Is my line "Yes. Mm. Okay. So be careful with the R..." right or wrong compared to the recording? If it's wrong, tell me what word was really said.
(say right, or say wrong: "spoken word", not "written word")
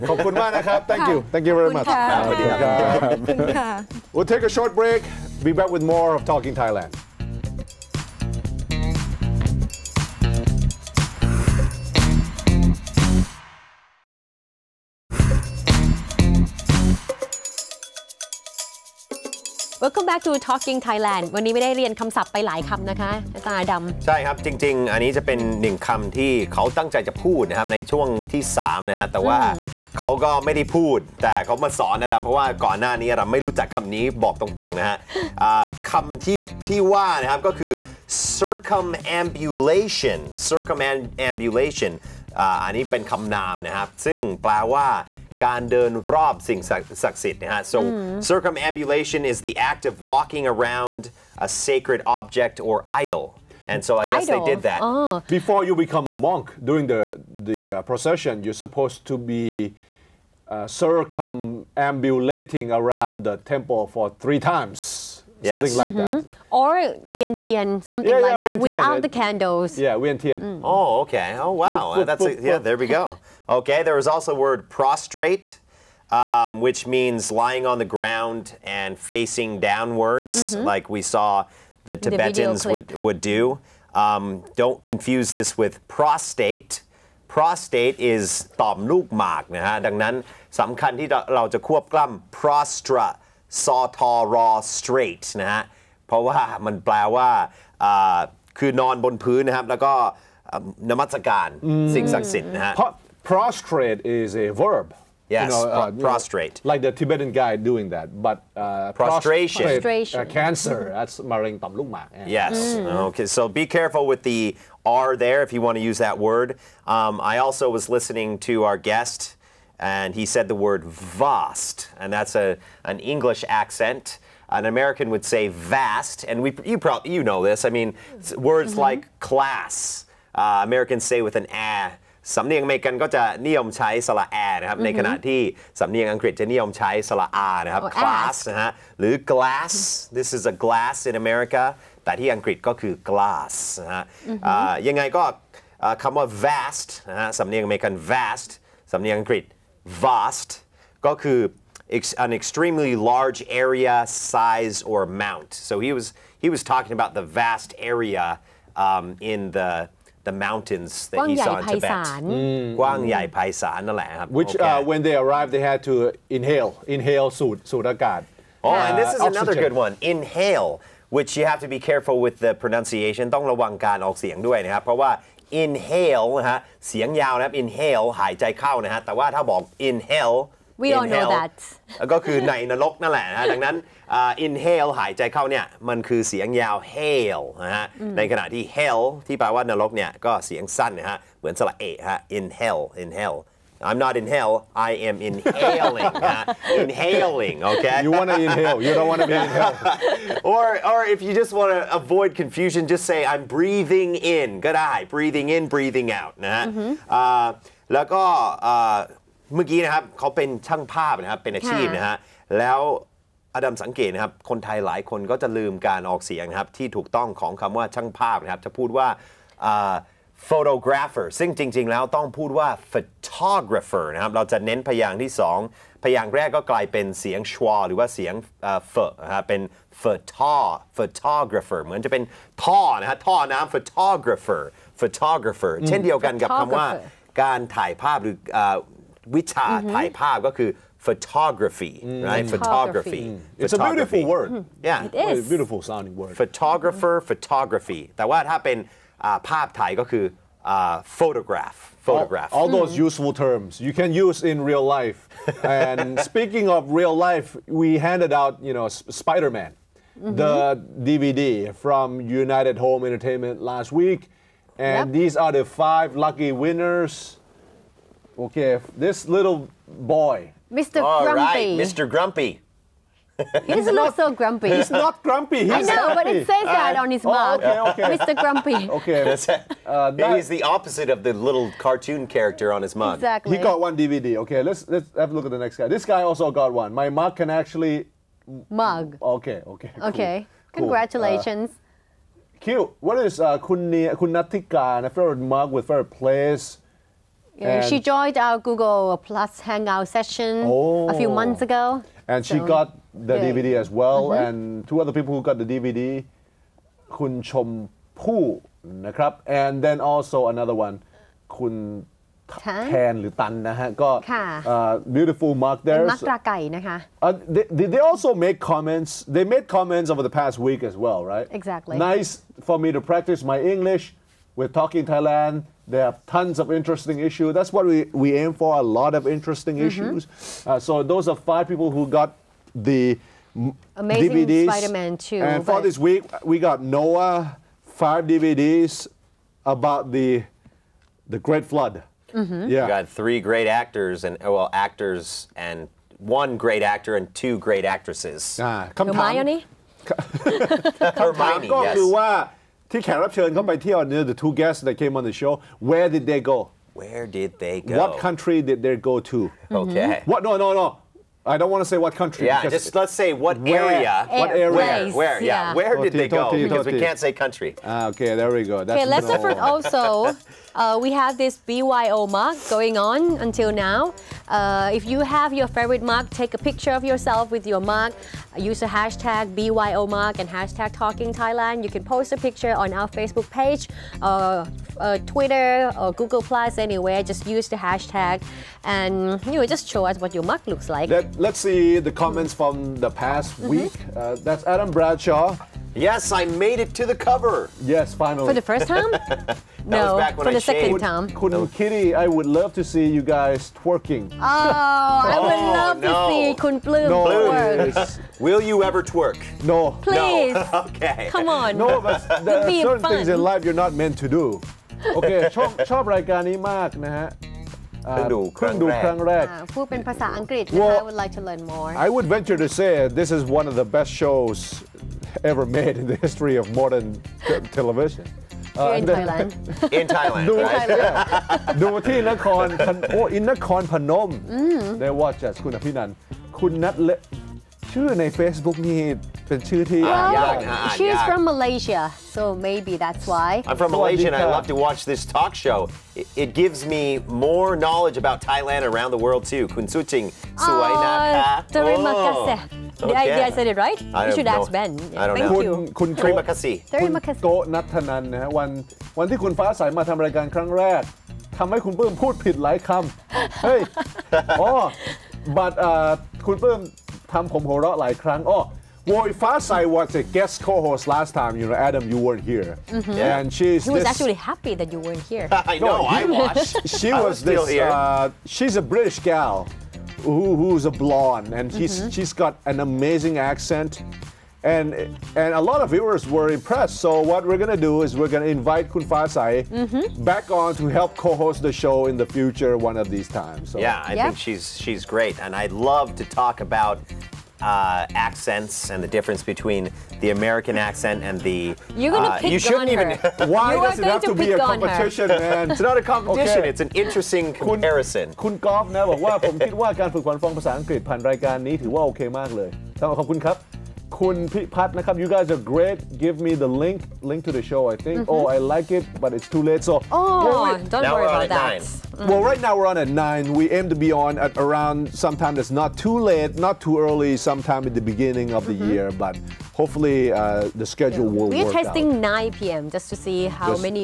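right.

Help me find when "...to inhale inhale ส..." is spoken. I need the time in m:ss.
2:45.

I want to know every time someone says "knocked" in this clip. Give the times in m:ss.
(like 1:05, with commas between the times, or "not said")
not said.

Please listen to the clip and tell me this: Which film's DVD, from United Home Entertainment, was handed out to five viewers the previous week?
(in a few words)
Spider-Man 2.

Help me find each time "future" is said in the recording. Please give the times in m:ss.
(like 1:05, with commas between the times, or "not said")
8:12.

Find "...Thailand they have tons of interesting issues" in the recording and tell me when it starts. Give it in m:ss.
5:25.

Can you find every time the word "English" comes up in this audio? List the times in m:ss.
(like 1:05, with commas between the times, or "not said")
2:02, 5:23.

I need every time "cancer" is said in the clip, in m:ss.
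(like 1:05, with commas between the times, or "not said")
1:50.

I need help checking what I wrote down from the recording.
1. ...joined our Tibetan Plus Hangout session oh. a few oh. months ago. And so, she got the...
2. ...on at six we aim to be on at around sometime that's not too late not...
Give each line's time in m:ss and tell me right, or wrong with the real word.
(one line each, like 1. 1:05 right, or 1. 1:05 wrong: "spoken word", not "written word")
1. 4:57 wrong: "Google", not "Tibetan"
2. 8:42 wrong: "nine", not "six".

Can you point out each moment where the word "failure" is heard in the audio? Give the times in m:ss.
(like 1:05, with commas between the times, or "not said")
not said.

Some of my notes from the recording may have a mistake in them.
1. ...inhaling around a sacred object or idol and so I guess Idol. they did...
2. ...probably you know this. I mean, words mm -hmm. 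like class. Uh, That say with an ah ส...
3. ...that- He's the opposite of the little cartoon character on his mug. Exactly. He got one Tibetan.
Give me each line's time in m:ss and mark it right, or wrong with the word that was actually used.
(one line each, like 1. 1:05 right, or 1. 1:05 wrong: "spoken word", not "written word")
1. 0:50 wrong: "walking", not "inhaling"
2. 2:06 wrong: "Americans", not "That"
3. 4:40 wrong: "DVD", not "Tibetan".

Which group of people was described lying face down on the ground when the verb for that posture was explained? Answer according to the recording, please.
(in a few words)
Tibetans.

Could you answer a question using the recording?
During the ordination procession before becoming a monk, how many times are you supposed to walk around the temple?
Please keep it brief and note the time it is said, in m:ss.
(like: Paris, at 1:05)
3, at 1:04.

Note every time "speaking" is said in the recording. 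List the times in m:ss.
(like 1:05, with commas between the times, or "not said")
4:16.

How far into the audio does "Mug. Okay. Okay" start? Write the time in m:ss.
4:48.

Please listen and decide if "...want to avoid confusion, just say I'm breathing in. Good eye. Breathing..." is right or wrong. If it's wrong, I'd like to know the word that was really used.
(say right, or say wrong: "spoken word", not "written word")
right.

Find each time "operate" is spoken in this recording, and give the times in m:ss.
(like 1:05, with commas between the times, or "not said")
not said.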